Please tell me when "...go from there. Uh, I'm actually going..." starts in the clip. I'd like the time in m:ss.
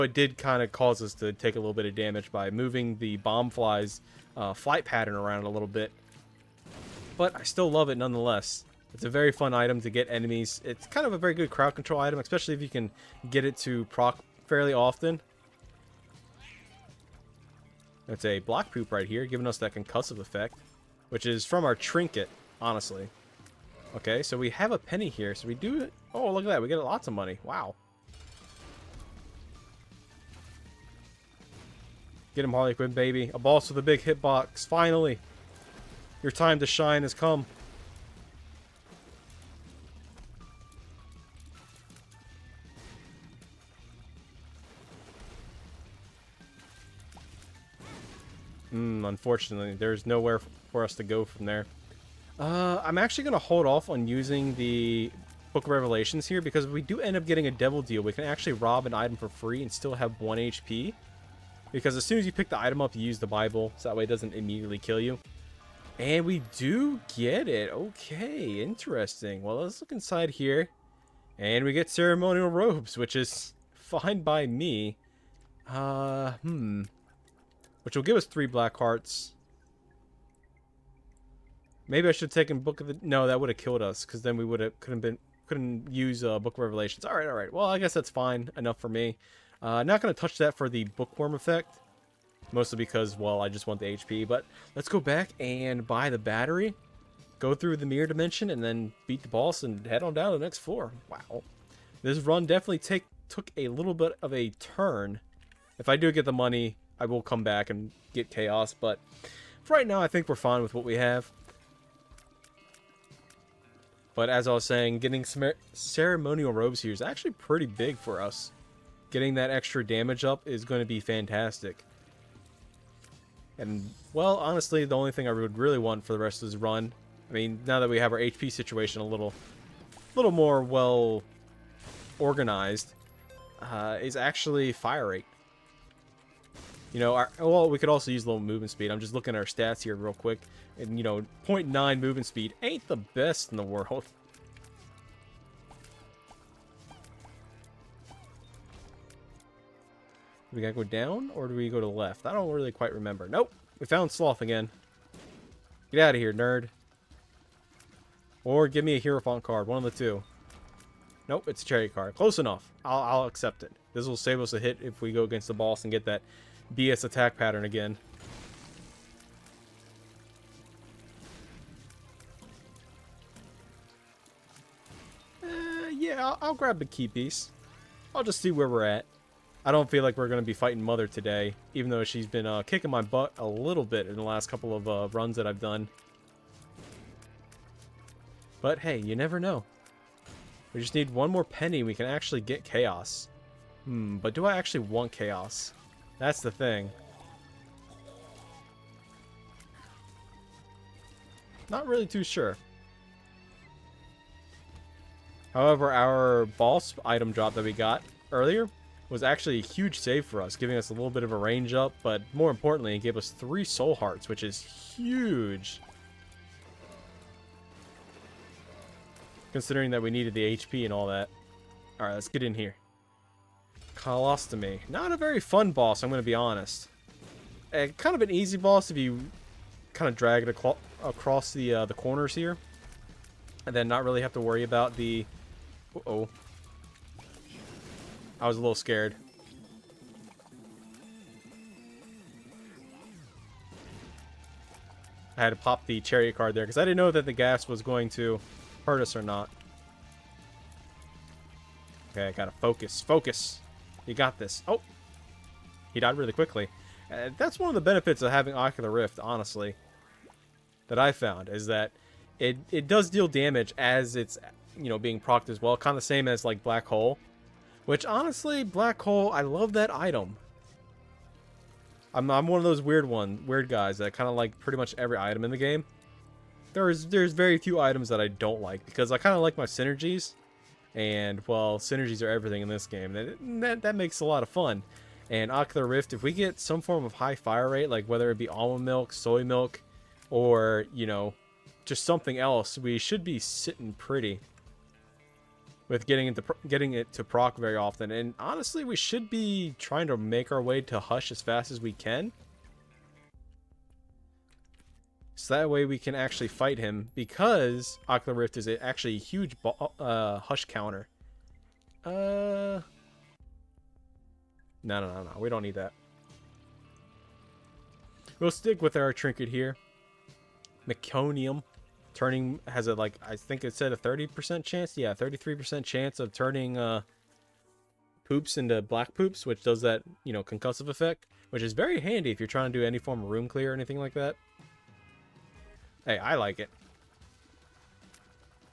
0:51.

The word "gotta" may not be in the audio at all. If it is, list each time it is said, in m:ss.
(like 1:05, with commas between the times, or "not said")
2:30, 4:12.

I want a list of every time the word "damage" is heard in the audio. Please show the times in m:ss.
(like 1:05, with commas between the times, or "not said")
0:01, 1:59, 4:23.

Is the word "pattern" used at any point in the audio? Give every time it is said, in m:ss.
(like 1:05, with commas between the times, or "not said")
0:04, 2:47.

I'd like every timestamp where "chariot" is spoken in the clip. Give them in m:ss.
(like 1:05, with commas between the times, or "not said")
2:41, 4:06.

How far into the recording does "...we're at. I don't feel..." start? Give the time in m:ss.
2:58.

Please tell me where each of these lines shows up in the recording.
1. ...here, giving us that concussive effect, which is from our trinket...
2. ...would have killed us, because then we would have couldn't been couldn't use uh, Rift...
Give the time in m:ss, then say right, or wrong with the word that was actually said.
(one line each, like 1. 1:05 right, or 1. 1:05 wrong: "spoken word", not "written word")
1. 0:19 right
2. 1:23 wrong: "Book", not "Rift".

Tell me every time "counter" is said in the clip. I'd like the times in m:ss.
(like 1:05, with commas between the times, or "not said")
5:10.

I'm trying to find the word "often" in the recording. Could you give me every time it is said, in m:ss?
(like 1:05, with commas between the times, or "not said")
0:14, 4:57.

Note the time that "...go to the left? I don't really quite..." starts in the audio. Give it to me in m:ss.
2:31.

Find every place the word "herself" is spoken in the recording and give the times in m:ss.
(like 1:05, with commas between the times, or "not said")
not said.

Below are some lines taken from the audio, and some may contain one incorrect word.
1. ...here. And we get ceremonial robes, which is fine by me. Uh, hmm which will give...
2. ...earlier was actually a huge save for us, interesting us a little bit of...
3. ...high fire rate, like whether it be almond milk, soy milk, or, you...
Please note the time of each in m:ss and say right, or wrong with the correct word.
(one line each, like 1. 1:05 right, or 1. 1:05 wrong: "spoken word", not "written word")
1. 1:10 right
2. 3:28 wrong: "giving", not "interesting"
3. 4:47 right.